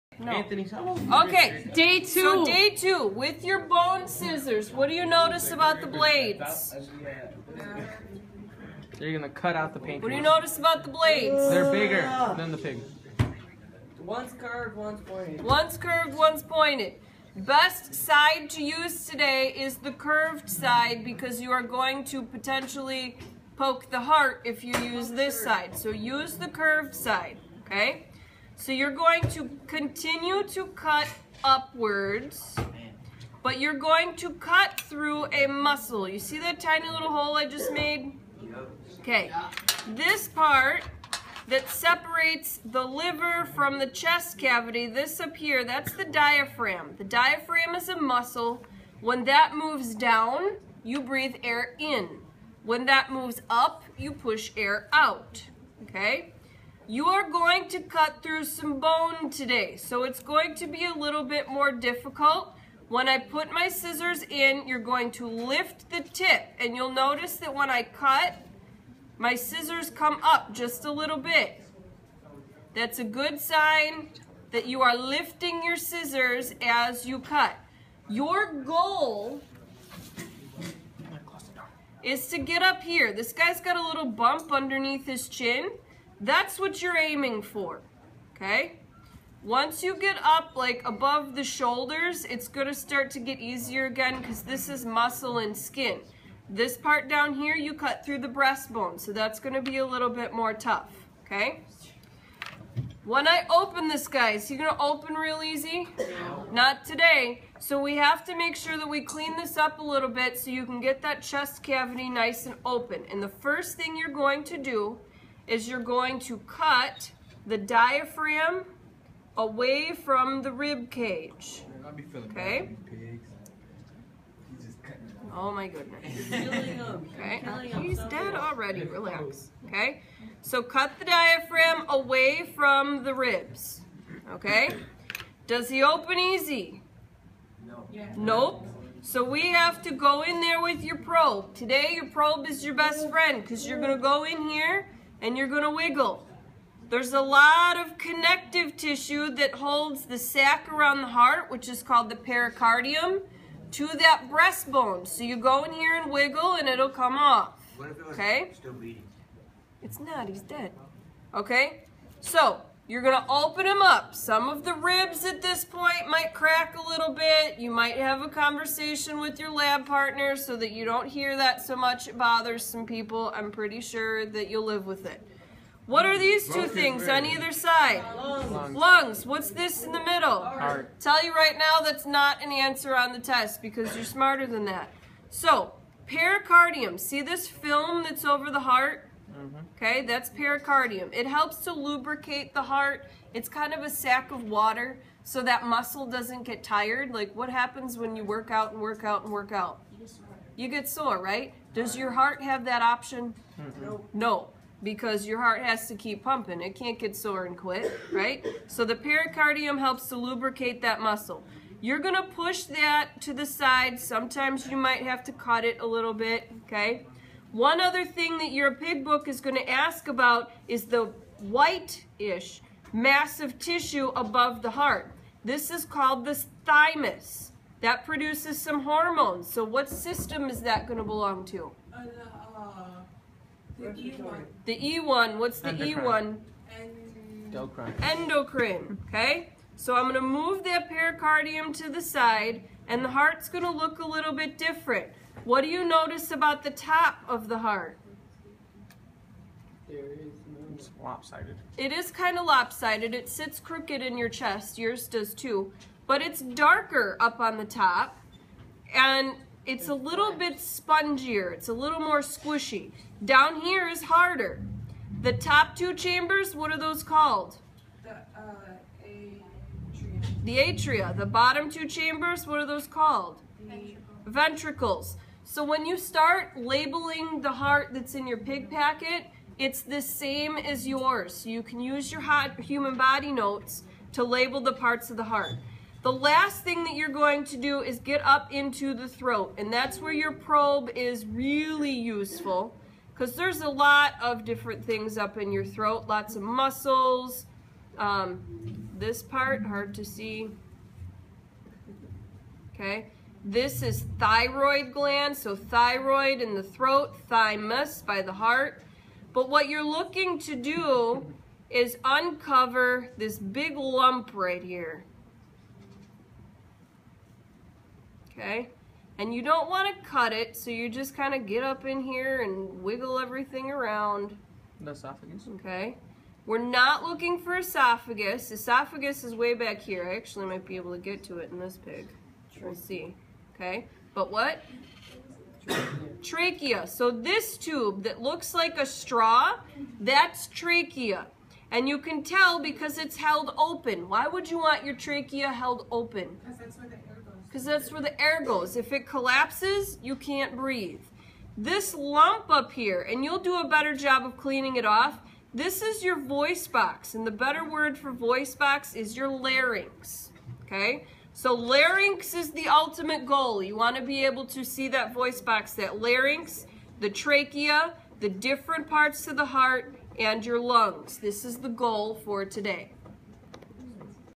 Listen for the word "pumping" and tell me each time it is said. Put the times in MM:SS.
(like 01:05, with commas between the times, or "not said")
03:26.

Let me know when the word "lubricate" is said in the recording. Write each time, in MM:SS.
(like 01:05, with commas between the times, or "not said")
03:11, 03:30.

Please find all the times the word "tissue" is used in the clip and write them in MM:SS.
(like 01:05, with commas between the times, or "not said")
02:28, 03:43.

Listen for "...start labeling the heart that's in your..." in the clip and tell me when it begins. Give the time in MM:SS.
04:35.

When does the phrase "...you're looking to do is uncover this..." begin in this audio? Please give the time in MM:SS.
05:09.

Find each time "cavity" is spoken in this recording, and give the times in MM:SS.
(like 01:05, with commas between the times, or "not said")
00:44, 01:51.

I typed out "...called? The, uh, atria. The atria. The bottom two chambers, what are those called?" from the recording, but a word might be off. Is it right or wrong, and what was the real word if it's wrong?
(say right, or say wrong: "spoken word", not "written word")
right.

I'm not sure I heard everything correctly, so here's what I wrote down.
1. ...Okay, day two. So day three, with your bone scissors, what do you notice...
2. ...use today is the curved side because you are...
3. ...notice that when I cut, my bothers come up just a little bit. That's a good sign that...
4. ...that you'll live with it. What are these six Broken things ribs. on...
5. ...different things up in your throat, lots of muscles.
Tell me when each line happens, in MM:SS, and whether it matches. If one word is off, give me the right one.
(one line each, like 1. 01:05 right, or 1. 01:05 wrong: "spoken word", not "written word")
1. 00:01 wrong: "two", not "three"
2. 00:18 right
3. 01:06 wrong: "scissors", not "bothers"
4. 02:54 wrong: "two", not "six"
5. 04:54 right.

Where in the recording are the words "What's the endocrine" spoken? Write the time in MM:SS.
03:55.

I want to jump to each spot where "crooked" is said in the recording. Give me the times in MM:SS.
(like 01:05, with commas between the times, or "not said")
04:13.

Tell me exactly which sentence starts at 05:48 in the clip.
If it collapses, you can't breathe.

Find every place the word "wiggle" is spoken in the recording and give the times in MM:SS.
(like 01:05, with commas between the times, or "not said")
02:25, 02:36, 05:22.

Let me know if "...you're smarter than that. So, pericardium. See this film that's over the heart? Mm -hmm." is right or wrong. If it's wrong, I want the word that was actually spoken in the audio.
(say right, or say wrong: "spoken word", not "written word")
right.